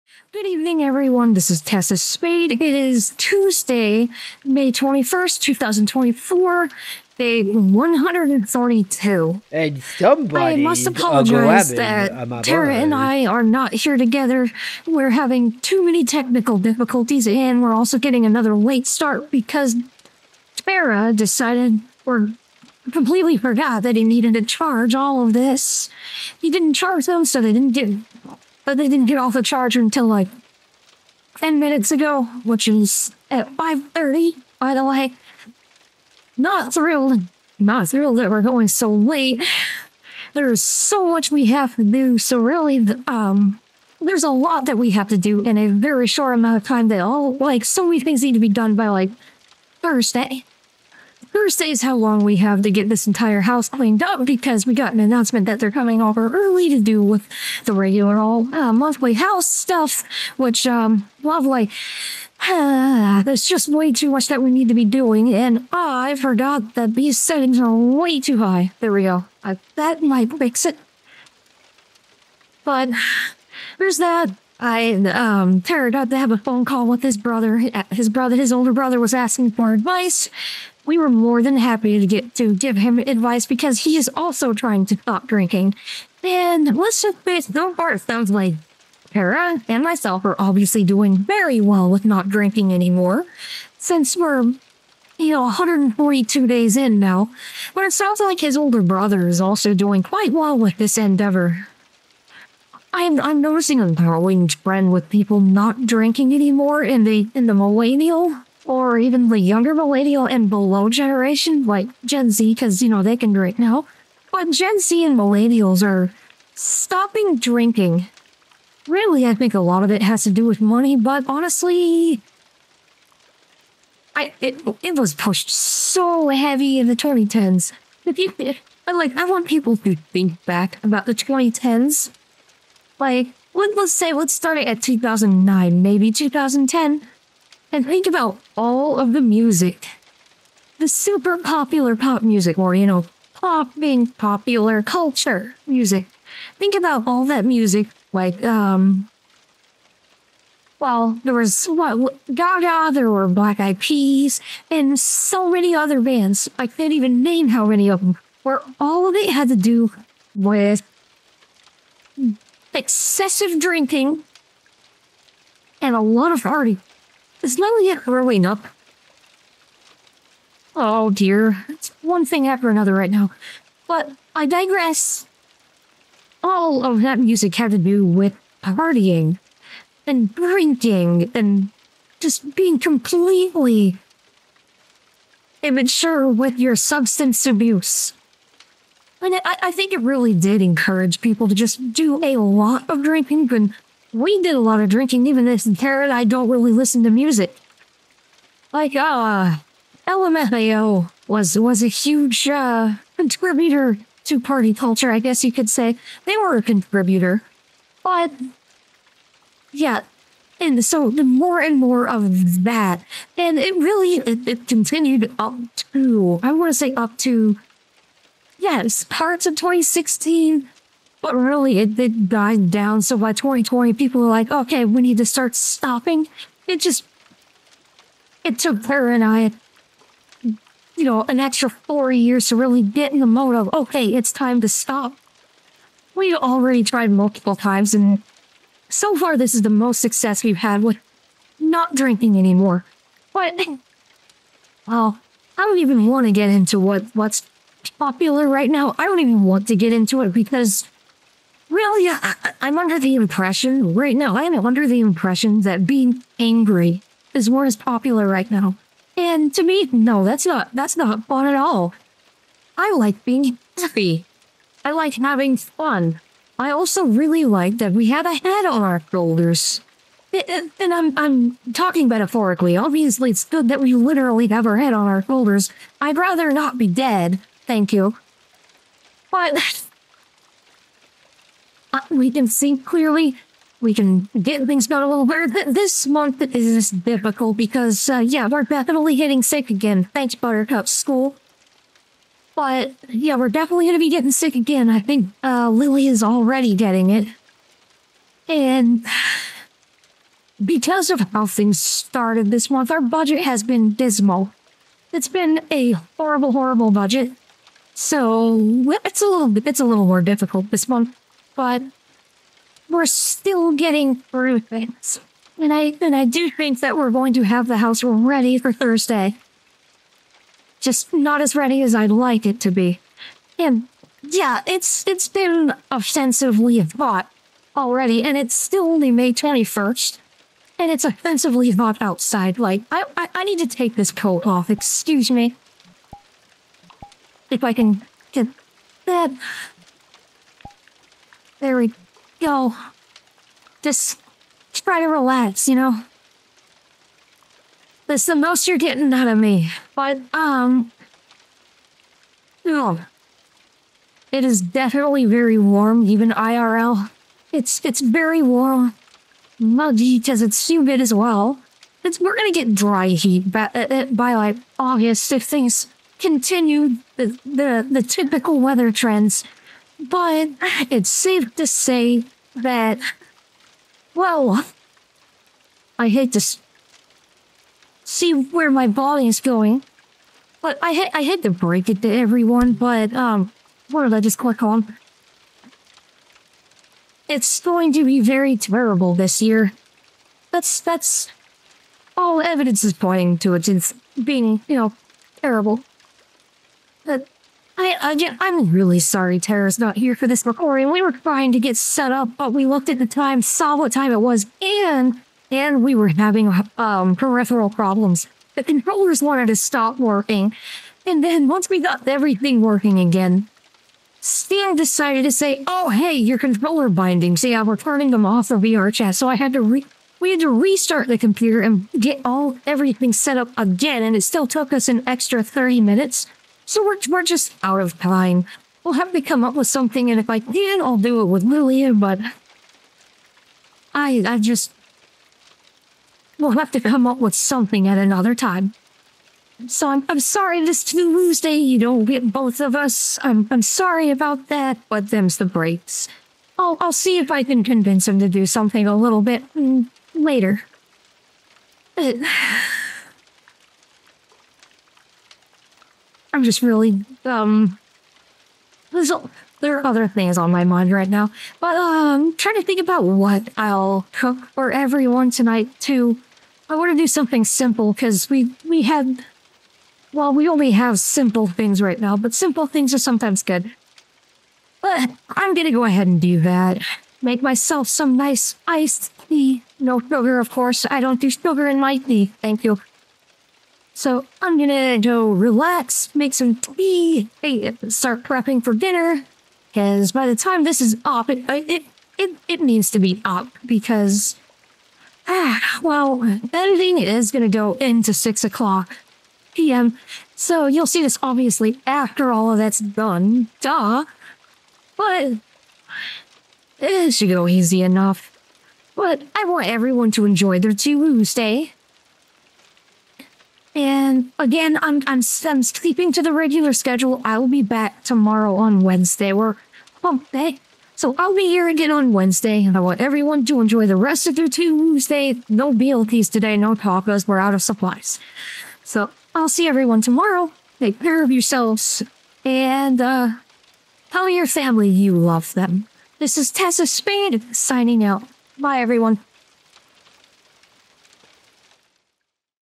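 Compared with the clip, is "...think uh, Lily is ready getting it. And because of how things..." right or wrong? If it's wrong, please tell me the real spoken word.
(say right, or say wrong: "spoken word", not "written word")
wrong: "already", not "ready".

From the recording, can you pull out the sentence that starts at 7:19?
So I'm I'm sorry this Tuesday you don't get both of us.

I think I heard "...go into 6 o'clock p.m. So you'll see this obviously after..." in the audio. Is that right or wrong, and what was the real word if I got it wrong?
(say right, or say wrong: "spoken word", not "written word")
right.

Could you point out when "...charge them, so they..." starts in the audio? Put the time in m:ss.
0:26.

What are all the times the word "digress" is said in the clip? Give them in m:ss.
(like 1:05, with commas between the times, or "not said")
2:54.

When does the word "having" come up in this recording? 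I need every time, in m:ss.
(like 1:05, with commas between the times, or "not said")
0:15, 4:25, 6:46.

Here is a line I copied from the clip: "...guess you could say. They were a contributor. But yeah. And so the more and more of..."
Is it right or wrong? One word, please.
right.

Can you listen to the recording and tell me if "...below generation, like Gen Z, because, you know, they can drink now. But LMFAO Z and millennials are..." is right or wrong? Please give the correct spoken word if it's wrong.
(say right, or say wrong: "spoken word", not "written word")
wrong: "Gen", not "LMFAO".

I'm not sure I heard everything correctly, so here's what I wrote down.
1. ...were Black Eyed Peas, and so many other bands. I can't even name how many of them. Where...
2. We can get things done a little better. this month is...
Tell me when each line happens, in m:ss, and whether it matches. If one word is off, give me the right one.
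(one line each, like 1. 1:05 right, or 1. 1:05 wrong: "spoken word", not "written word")
1. 2:33 right
2. 4:43 right.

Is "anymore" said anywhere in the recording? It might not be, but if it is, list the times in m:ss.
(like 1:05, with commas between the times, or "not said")
1:32, 1:46, 4:02.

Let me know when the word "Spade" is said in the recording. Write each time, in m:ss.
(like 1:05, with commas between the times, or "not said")
0:01, 8:56.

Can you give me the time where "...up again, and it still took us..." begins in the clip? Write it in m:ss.
7:03.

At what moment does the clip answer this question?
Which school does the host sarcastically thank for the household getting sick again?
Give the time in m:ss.
4:50.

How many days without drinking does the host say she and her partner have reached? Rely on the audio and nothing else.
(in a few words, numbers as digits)
142.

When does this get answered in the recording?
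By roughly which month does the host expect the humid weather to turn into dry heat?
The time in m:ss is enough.
6:04.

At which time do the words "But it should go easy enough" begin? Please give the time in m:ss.
8:24.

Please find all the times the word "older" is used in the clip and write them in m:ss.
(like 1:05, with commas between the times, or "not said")
1:18, 1:38.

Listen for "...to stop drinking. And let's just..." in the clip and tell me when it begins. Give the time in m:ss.
1:24.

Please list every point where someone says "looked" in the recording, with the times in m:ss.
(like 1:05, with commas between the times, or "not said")
6:42.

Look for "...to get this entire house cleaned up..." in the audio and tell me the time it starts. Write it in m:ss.
0:52.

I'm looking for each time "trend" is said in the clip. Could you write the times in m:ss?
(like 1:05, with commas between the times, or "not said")
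1:44, 6:08.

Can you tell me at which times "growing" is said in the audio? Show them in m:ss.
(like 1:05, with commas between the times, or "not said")
1:43, 2:47.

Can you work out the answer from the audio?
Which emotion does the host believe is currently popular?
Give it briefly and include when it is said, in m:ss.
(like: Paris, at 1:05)
Being angry, at 4:15.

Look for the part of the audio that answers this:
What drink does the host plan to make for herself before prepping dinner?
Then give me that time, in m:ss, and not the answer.
7:58.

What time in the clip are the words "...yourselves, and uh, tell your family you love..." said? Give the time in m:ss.
8:51.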